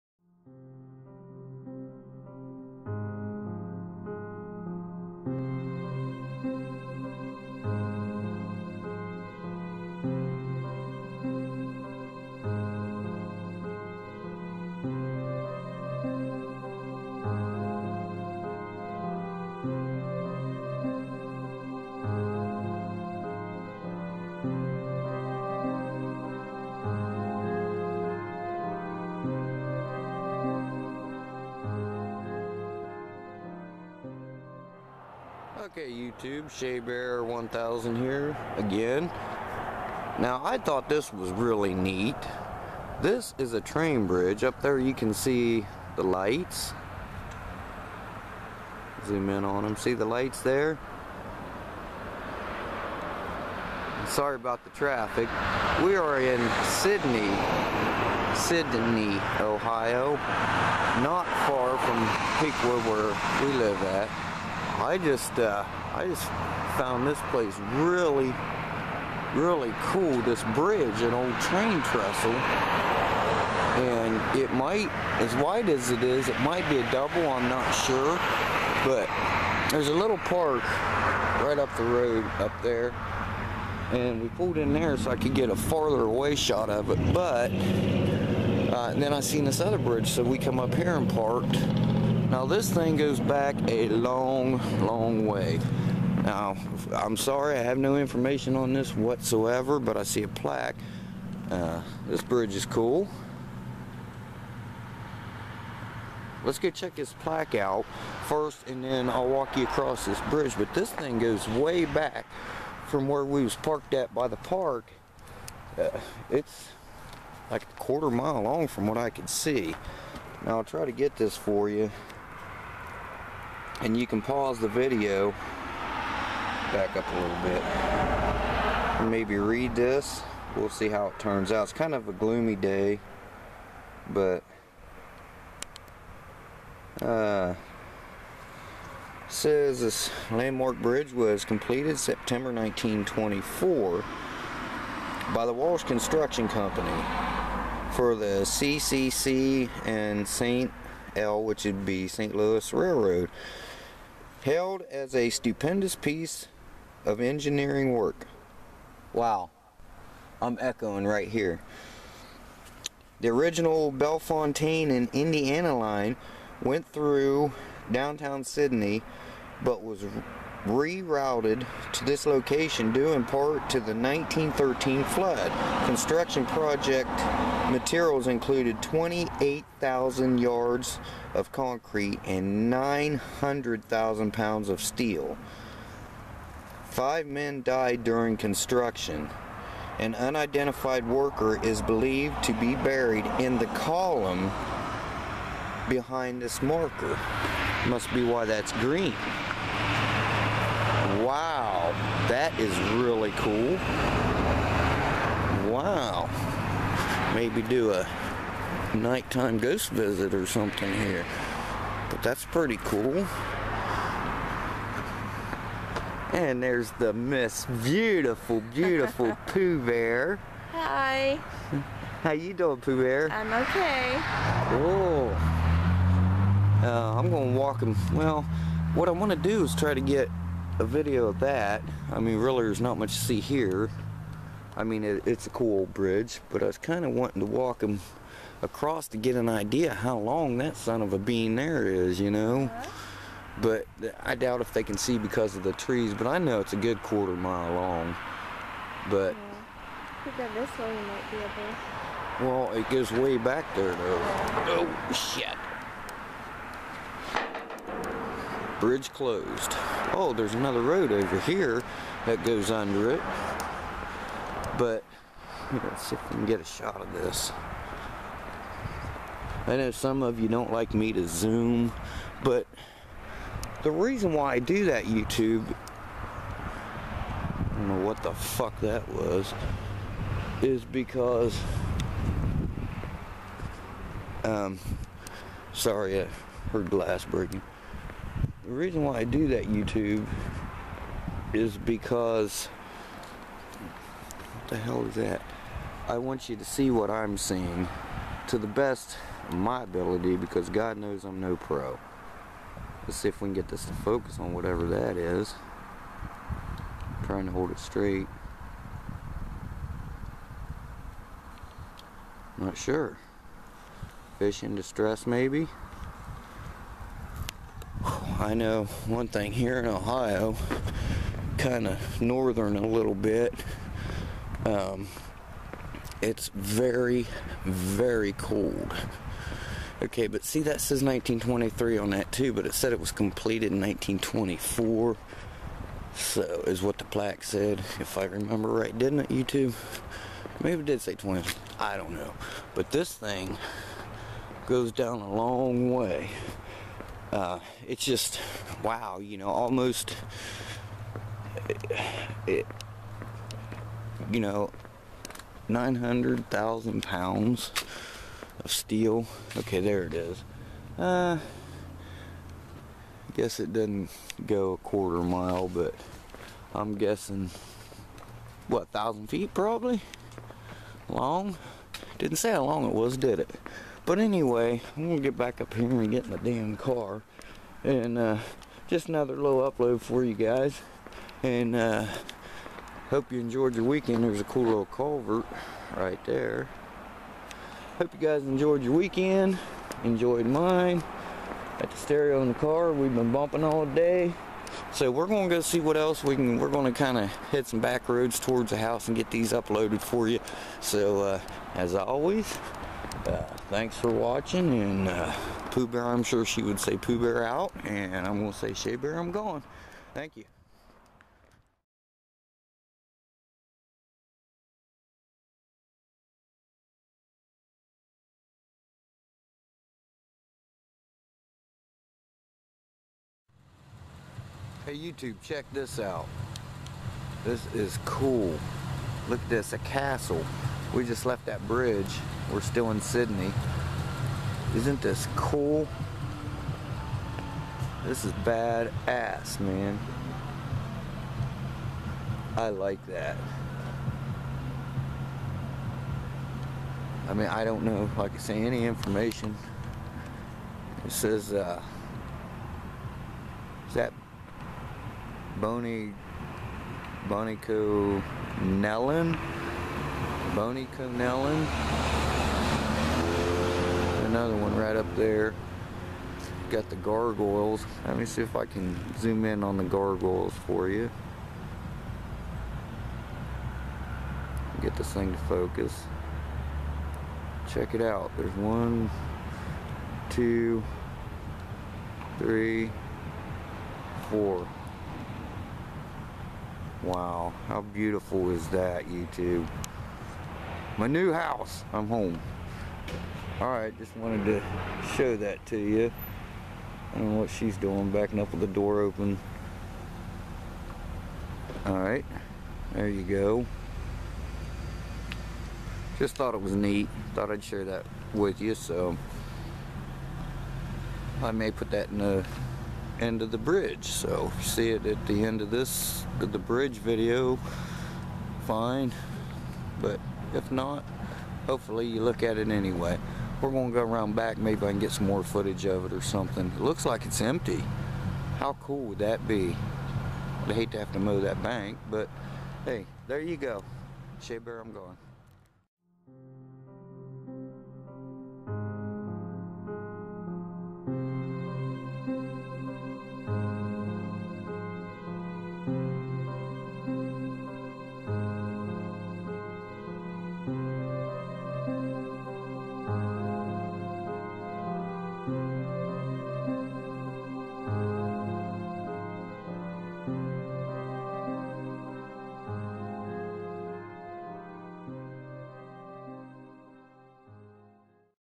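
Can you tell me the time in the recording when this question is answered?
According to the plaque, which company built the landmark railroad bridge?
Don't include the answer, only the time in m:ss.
2:25.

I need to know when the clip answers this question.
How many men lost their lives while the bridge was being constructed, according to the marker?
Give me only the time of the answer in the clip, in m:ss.
3:06.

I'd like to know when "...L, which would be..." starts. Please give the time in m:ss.
2:31.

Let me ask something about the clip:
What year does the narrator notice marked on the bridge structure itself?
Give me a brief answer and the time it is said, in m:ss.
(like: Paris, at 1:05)
1923, at 5:31.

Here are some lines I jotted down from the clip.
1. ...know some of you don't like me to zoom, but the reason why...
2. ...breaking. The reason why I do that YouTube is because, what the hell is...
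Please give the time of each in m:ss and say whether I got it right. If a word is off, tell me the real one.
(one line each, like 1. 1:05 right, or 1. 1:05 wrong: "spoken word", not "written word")
1. 4:29 right
2. 4:47 right.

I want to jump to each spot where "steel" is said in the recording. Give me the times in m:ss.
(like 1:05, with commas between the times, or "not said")
3:04, 5:58.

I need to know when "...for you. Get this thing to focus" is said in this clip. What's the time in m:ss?
7:50.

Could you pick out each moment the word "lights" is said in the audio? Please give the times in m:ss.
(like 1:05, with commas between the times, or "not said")
0:46, 0:50.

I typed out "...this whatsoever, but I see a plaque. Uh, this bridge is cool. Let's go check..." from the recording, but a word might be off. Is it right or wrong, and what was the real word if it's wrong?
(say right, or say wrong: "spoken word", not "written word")
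right.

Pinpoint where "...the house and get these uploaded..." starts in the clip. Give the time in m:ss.
6:38.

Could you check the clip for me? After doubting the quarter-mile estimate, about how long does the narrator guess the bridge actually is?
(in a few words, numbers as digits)
1,000 feet.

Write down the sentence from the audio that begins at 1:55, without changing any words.
Uh, it's like a quarter mile long from what I could see.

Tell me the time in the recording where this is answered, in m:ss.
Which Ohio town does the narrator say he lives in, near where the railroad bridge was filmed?
1:02.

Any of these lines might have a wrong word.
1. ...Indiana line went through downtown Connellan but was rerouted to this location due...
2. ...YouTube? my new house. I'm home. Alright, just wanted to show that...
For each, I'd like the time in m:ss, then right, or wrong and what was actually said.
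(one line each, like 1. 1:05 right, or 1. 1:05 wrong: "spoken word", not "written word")
1. 2:45 wrong: "Sidney", not "Connellan"
2. 8:09 right.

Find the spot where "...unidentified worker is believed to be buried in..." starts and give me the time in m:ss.
3:10.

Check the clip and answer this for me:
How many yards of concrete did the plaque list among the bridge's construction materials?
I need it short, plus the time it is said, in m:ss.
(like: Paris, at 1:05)
28,000, at 2:58.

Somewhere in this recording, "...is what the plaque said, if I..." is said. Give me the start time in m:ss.
5:36.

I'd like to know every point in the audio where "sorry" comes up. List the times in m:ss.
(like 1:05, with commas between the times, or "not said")
0:54, 1:37, 4:45.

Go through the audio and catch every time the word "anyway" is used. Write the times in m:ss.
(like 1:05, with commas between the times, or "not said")
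6:14, 8:42.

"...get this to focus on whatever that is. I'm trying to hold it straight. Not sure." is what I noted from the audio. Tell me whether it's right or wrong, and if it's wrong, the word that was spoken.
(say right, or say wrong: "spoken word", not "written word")
right.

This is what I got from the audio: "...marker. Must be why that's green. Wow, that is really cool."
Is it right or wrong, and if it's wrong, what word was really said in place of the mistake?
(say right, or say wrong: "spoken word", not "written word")
right.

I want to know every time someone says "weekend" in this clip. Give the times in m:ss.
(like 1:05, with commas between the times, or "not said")
6:23, 6:28.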